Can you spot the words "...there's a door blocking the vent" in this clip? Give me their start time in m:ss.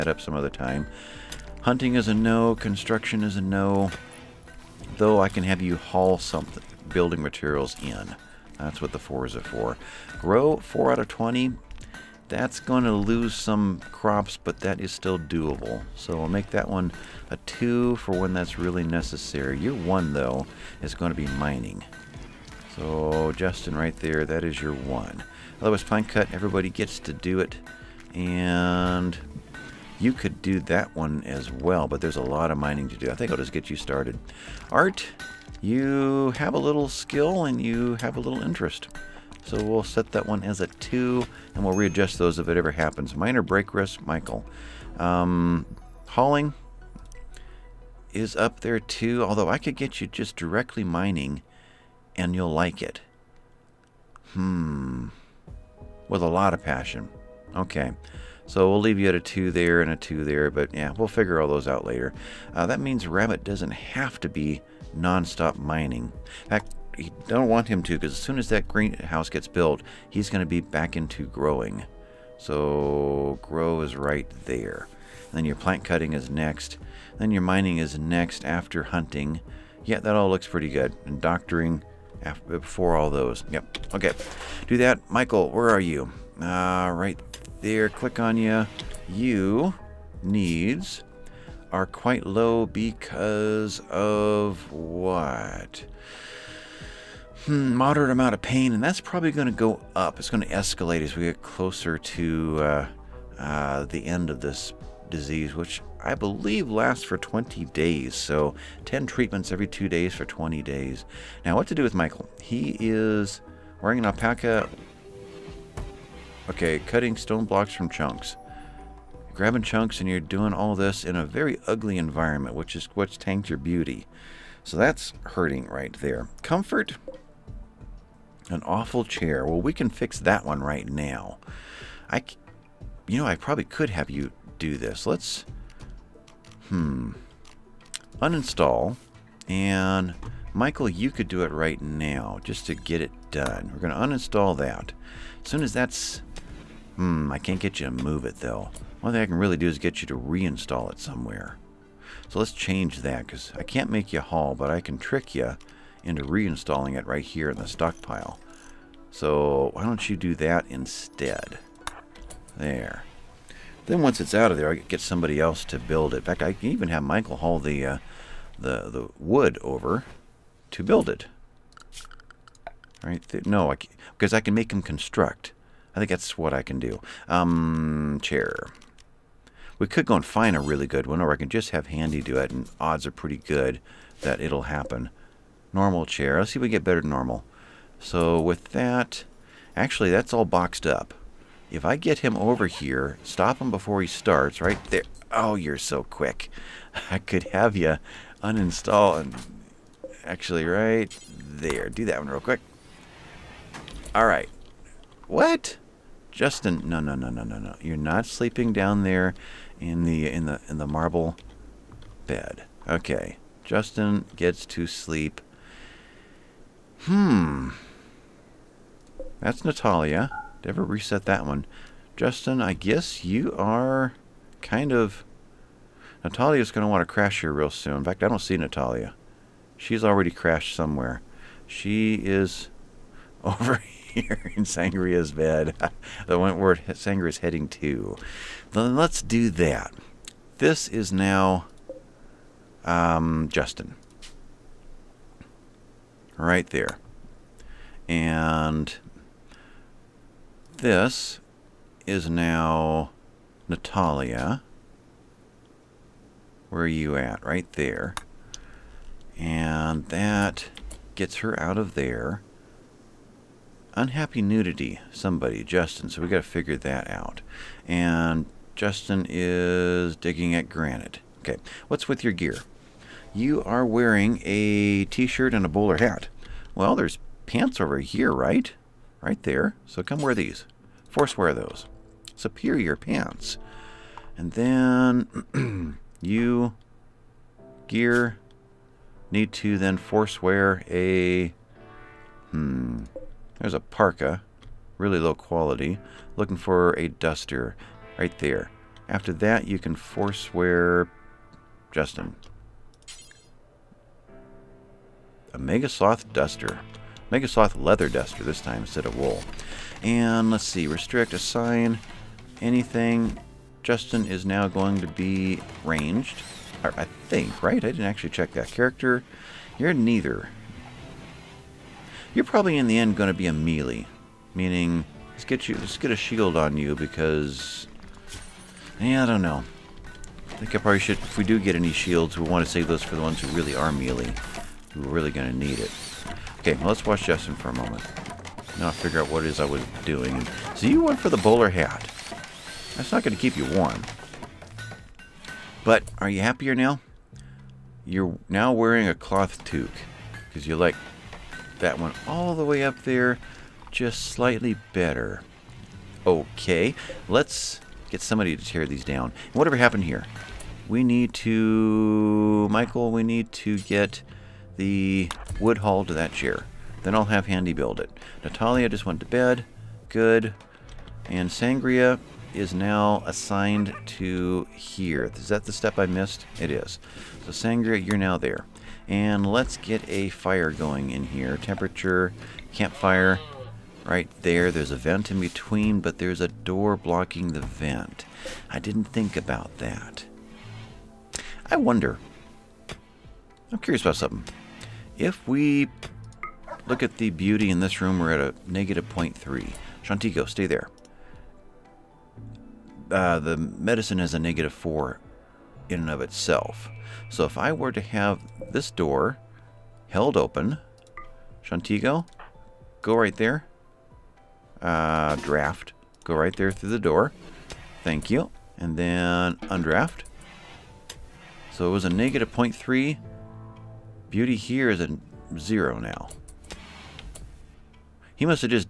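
6:26.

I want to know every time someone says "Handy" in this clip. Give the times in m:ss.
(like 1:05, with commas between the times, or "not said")
3:01, 6:07.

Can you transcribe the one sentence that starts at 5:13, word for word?
Justin is now going to be ranged.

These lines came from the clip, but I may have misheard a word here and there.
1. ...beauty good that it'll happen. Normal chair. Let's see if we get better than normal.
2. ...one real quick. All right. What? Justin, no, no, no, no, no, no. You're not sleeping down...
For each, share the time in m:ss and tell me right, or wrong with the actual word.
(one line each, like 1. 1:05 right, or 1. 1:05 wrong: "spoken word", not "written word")
1. 3:03 wrong: "pretty", not "beauty"
2. 3:22 right.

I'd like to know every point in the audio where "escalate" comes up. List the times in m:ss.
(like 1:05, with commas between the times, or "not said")
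1:40.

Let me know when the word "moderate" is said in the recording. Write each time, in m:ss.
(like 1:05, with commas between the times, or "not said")
1:37.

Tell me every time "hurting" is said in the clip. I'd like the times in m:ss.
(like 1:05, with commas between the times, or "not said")
2:05.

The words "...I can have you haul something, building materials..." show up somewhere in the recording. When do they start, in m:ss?
0:05.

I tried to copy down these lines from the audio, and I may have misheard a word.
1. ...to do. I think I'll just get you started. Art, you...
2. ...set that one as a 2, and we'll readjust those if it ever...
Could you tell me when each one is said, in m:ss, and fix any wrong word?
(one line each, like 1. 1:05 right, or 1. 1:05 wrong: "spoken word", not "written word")
1. 0:32 right
2. 0:39 right.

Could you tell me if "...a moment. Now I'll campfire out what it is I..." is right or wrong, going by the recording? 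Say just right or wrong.
wrong.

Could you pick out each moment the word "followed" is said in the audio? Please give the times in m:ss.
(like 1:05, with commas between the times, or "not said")
not said.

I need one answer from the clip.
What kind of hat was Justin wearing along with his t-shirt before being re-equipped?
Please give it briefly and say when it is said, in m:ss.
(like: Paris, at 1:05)
A bowler hat, at 4:35.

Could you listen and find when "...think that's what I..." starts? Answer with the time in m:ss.
2:56.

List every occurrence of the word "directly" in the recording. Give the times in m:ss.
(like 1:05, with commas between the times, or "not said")
0:50.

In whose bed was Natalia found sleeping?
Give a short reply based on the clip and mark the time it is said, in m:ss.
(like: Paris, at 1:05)
Sangria's bed, at 3:54.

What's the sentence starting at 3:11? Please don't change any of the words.
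If I get him over here, stop him before he starts, right there.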